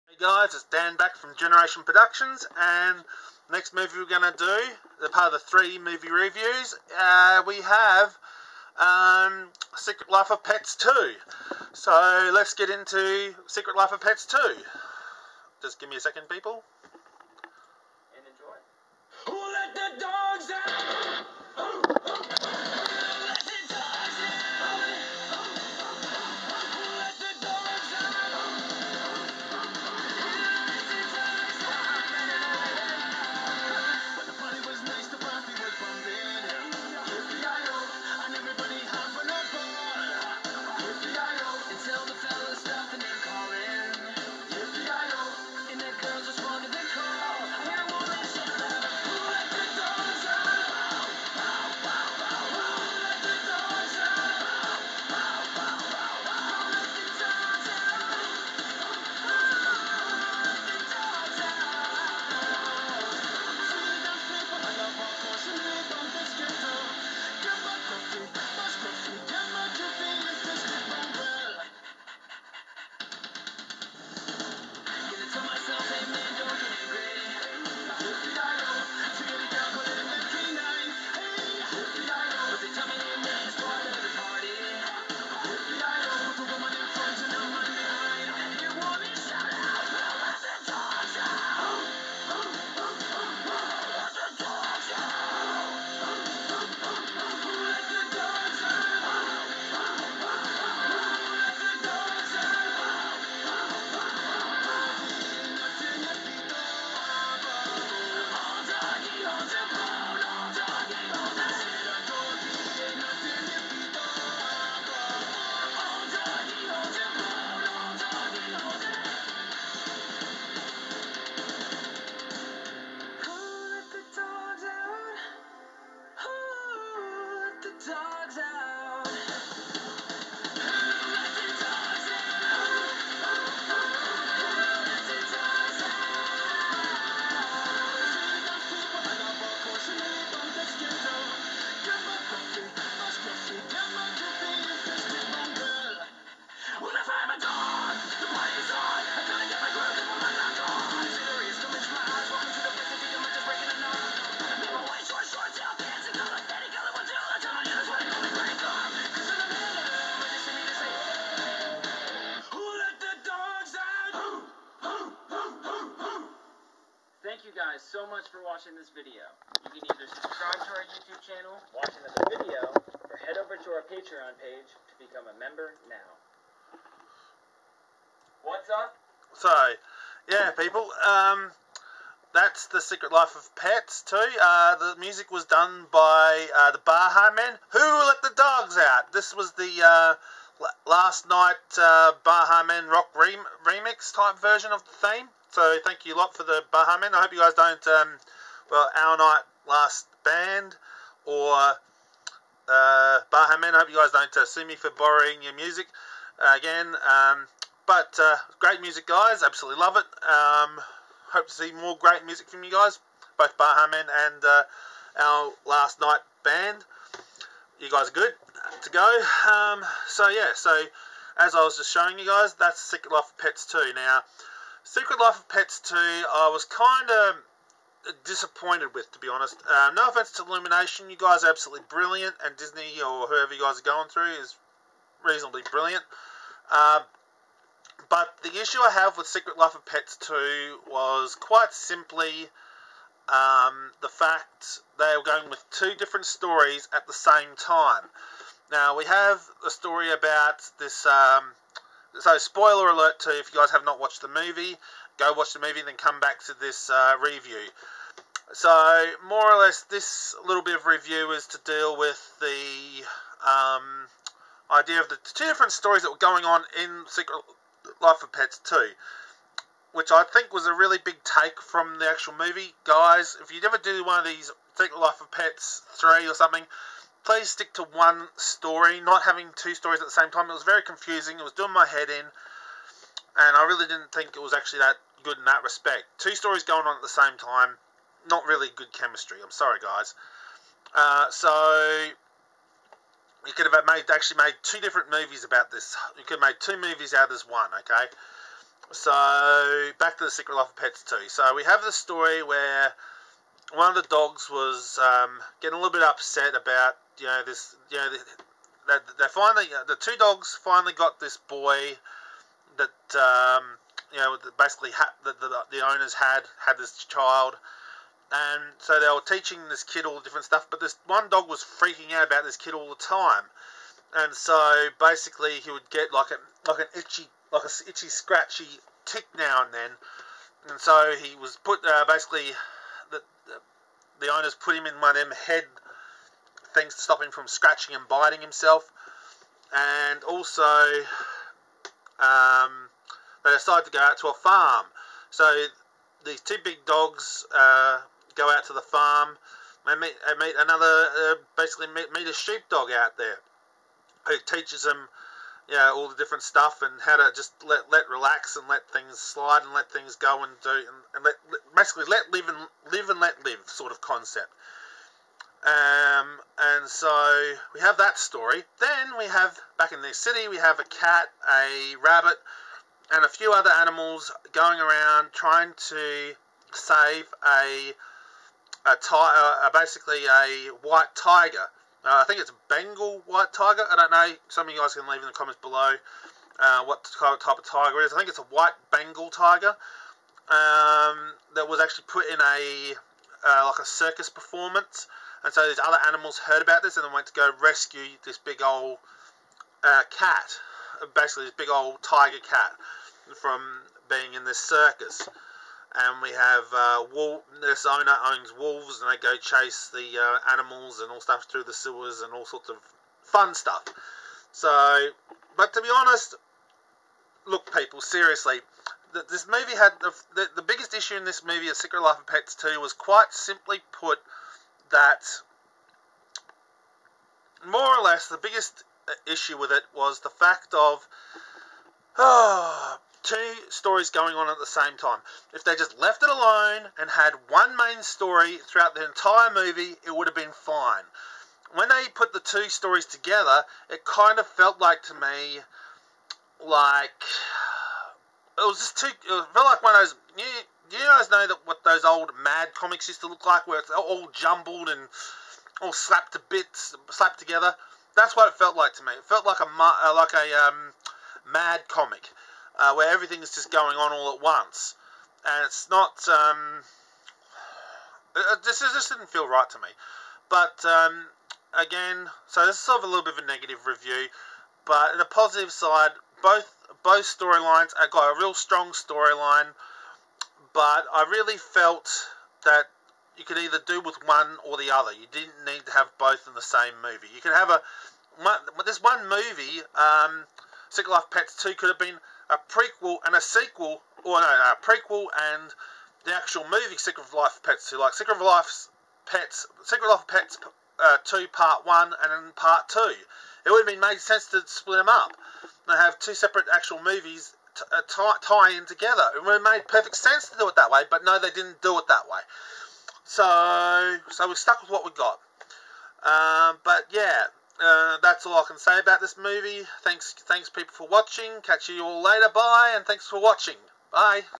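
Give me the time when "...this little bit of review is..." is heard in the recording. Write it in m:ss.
4:19.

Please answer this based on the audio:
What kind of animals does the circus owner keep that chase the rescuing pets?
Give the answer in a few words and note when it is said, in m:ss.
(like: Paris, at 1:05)
wolves, at 6:48.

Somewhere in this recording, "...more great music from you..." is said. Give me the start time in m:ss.
3:31.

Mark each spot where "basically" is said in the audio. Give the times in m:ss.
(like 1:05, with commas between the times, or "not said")
5:14, 5:24, 5:32, 5:51, 6:01, 6:19, 6:41.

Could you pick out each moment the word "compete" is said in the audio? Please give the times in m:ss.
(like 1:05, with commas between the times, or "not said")
not said.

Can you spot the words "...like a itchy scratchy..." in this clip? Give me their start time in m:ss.
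5:27.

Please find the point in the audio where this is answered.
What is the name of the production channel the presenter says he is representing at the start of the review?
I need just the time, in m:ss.
0:01.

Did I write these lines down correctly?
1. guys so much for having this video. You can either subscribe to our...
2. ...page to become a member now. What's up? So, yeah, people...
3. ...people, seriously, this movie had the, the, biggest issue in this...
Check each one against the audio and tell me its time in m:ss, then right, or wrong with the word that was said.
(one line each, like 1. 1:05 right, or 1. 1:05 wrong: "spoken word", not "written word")
1. 2:47 wrong: "watching", not "having"
2. 2:54 right
3. 6:57 right.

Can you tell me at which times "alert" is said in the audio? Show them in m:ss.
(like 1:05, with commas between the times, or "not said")
4:12.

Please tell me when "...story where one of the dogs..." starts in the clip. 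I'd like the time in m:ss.
5:01.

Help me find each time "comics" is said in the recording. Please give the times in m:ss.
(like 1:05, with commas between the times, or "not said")
7:32, 7:41.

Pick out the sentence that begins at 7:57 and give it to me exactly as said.
I got a real strong storyline, but I really felt that you could either do with one or the other.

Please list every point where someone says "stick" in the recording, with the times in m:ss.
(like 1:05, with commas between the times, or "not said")
4:37.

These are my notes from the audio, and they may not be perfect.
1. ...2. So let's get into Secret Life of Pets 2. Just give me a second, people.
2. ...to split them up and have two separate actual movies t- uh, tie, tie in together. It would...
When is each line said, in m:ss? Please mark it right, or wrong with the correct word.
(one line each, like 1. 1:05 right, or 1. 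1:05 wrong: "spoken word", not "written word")
1. 0:10 right
2. 8:24 right.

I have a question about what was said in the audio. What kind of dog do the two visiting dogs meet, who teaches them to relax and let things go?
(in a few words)
sheepdog.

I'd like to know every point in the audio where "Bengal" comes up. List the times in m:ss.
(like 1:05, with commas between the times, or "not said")
6:22, 6:28.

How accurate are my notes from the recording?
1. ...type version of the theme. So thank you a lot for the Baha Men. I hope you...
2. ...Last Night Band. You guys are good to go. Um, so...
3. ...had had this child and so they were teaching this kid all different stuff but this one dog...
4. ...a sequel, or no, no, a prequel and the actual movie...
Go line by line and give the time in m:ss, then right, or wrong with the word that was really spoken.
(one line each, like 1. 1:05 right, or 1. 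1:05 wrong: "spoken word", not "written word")
1. 3:14 right
2. 3:35 right
3. 5:16 right
4. 8:13 right.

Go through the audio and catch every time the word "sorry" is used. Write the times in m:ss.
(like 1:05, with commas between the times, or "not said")
4:49.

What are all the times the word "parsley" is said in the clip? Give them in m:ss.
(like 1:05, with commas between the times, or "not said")
not said.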